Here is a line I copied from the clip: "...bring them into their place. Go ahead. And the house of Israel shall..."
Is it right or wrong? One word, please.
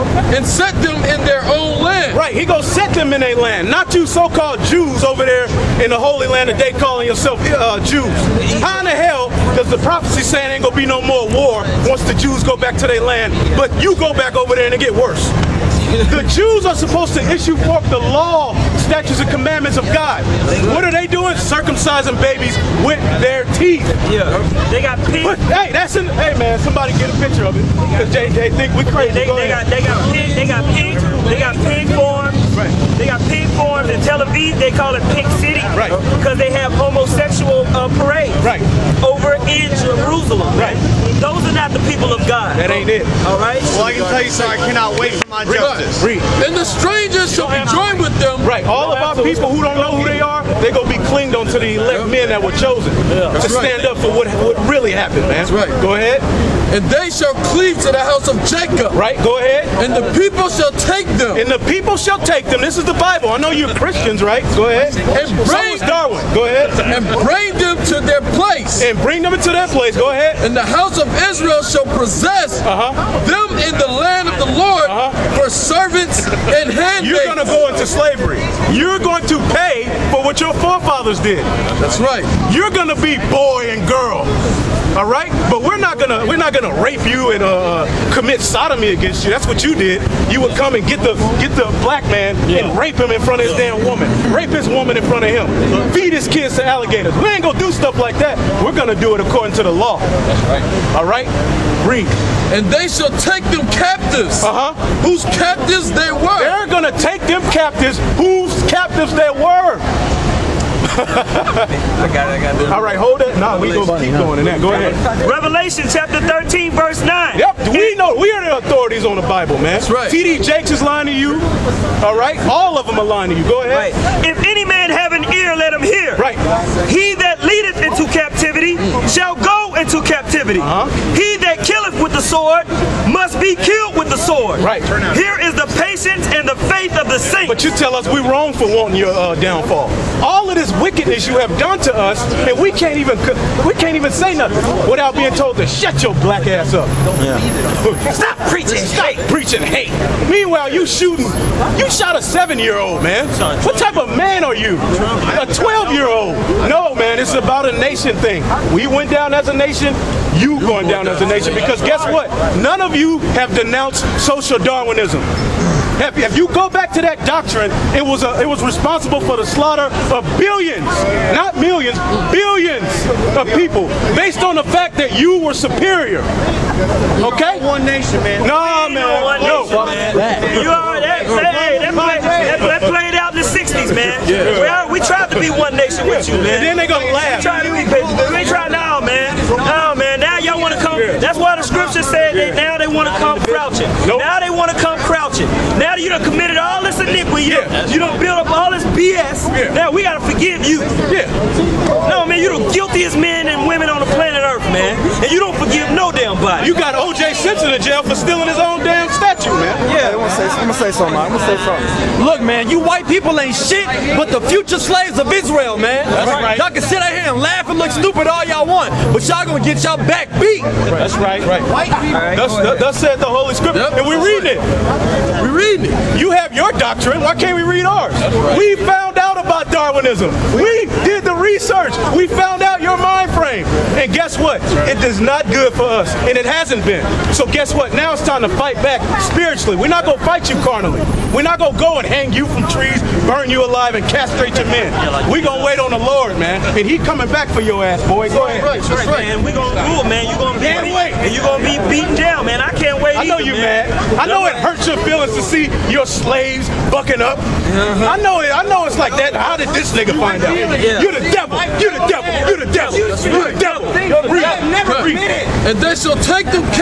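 right.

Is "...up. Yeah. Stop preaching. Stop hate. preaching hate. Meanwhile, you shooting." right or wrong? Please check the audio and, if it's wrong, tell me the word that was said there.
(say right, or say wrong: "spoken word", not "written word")
right.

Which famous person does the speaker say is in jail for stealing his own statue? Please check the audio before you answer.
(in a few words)
O.J. Simpson.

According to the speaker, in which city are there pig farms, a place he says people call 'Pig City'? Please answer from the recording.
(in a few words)
Tel Aviv.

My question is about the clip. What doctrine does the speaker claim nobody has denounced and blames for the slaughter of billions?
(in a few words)
social Darwinism.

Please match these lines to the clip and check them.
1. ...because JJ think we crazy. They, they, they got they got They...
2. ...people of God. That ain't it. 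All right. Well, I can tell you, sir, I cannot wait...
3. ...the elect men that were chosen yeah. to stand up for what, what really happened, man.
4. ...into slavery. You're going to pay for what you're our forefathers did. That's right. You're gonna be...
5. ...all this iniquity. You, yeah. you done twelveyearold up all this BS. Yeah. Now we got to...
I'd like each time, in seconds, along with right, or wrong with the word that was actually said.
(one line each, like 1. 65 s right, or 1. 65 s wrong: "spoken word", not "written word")
1. 27 s right
2. 41 s right
3. 51 s right
4. 77 s right
5. 196 s wrong: "build", not "twelveyearold".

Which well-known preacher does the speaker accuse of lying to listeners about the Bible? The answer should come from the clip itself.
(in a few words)
TD Jakes.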